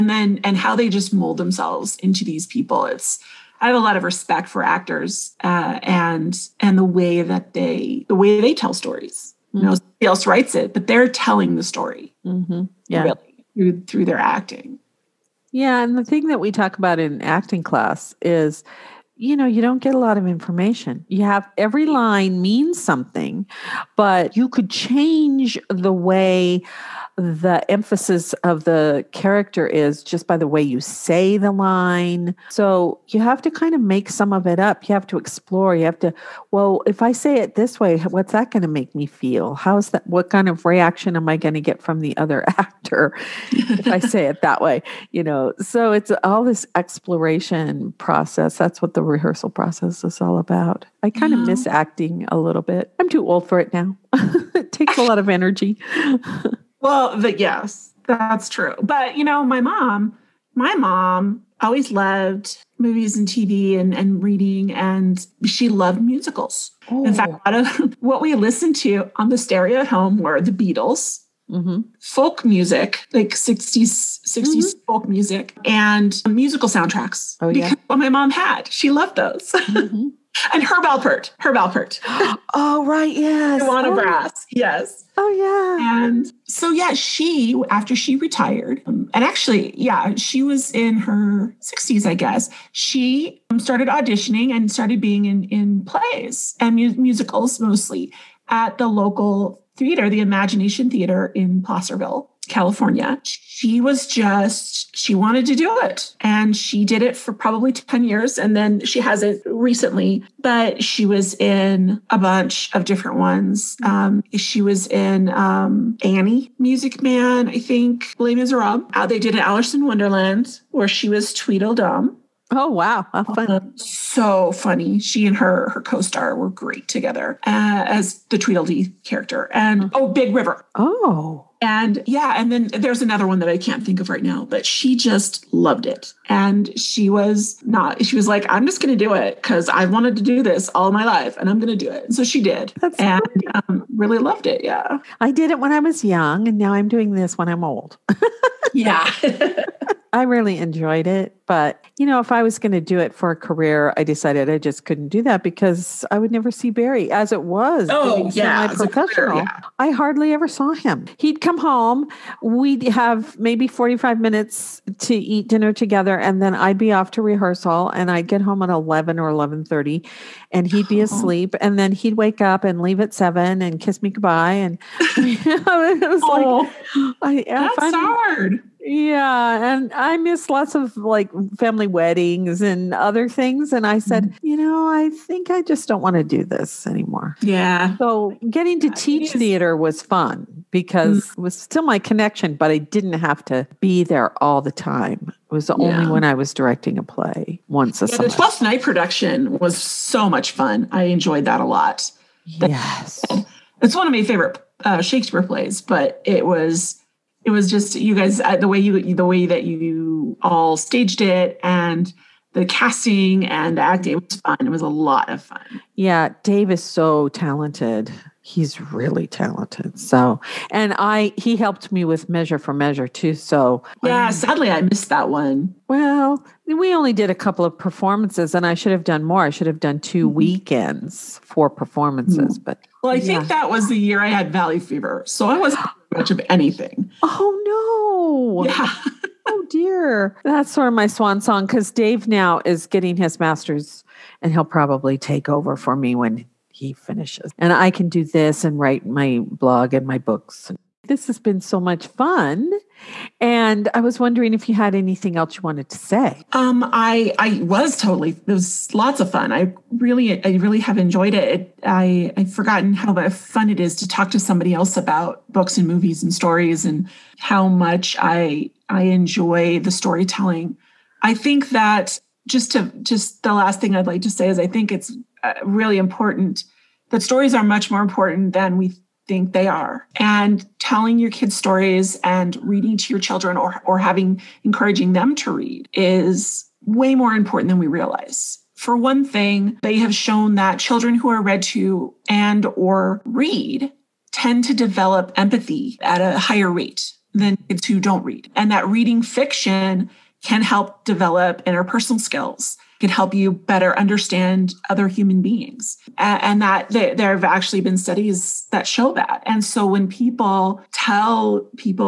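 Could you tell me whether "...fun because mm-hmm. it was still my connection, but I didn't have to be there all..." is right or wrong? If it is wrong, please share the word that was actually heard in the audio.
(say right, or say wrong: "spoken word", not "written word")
right.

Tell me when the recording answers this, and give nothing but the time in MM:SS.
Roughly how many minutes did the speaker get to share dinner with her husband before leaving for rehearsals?
02:43.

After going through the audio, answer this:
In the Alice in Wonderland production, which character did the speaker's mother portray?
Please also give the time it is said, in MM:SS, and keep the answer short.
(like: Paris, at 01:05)
Tweedledum, at 02:01.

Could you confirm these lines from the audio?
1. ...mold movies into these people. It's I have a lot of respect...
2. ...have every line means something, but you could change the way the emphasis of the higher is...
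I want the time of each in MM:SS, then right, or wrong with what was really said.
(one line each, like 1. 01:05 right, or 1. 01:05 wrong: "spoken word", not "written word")
1. 00:01 wrong: "themselves", not "movies"
2. 00:21 wrong: "character", not "higher".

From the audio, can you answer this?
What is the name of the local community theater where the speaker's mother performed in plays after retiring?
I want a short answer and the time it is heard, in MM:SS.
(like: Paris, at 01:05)
Imagination Theater, at 01:40.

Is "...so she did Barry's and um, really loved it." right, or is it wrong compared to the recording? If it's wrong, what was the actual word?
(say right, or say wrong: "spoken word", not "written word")
wrong: "That", not "Barry".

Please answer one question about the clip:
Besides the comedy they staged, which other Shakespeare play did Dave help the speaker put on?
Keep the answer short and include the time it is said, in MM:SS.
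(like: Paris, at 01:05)
Measure for Measure, at 03:42.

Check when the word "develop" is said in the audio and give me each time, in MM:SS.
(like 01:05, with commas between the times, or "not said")
04:54, 05:01.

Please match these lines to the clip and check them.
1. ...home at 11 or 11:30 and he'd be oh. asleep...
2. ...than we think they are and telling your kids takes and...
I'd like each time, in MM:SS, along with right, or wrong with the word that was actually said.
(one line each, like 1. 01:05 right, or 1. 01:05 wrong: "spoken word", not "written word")
1. 02:48 right
2. 04:38 wrong: "stories", not "takes".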